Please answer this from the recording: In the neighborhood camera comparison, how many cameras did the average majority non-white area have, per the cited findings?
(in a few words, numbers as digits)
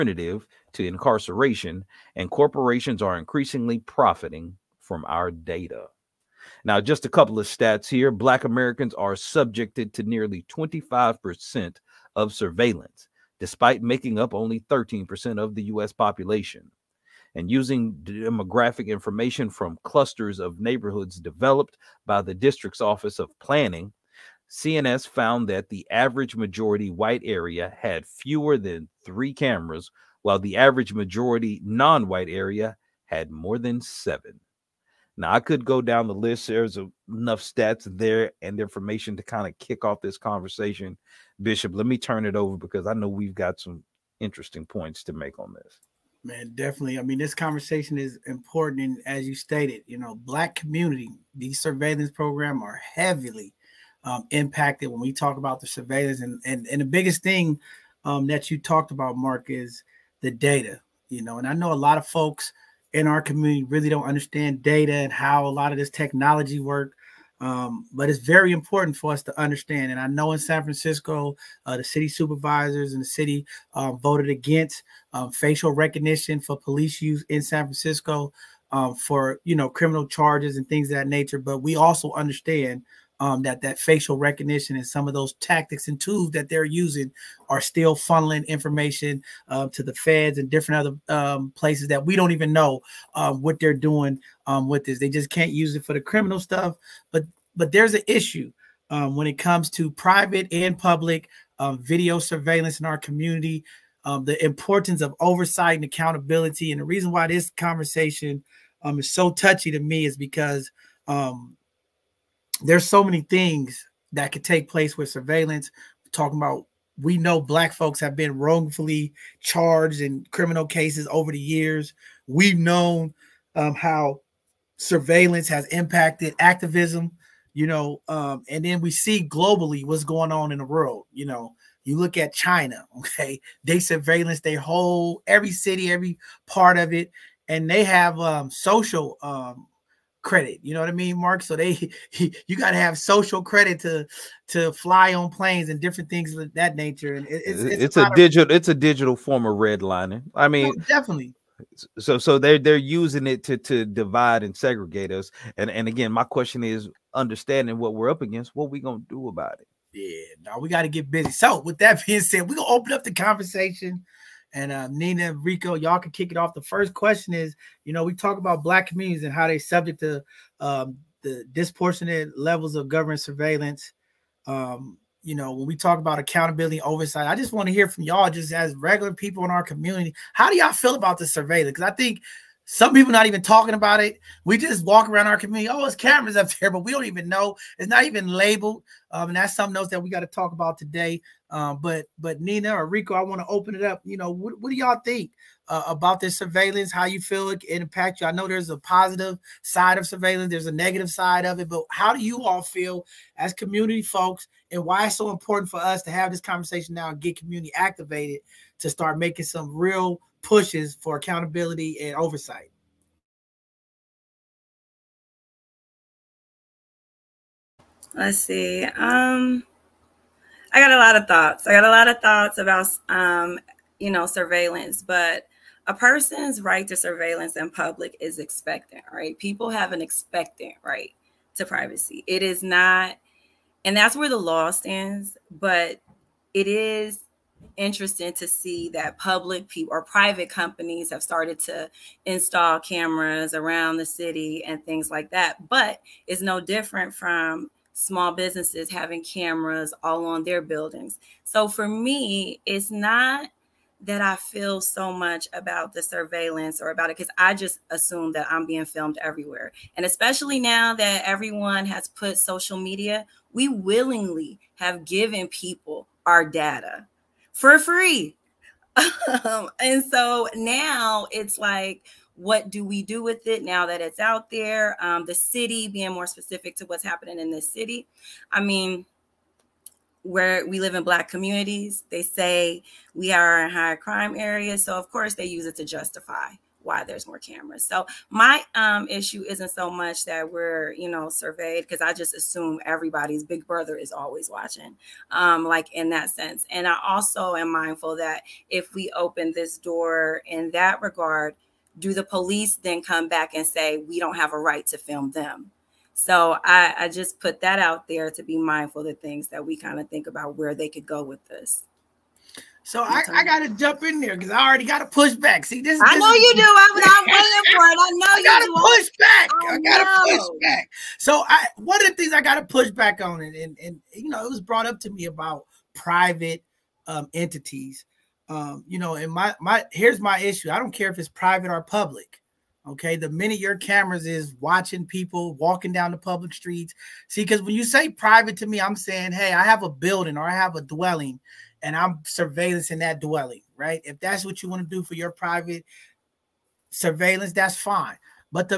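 more than 7.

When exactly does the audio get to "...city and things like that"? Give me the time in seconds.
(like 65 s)
244 s.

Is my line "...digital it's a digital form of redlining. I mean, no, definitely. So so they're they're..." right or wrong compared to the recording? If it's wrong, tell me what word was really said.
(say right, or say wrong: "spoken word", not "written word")
right.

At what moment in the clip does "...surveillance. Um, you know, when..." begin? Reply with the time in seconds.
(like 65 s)
173 s.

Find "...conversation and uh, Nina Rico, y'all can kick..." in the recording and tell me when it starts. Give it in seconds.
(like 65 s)
163 s.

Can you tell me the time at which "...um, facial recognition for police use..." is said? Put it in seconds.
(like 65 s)
75 s.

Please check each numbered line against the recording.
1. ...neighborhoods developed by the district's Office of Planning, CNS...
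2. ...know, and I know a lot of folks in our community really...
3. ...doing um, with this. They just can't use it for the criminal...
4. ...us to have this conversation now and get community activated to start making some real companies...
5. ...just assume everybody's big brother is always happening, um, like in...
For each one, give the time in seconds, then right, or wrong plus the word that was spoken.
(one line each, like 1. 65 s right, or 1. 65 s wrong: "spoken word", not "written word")
1. 20 s right
2. 61 s right
3. 93 s right
4. 205 s wrong: "pushes", not "companies"
5. 292 s wrong: "watching", not "happening".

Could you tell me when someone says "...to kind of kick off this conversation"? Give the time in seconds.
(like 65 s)
39 s.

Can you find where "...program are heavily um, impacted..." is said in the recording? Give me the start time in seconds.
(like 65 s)
52 s.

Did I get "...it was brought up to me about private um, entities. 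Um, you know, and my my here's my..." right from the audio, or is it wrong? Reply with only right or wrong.
right.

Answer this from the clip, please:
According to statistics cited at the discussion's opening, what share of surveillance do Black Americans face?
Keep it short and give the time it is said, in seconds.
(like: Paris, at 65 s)
nearly 25%, at 10 s.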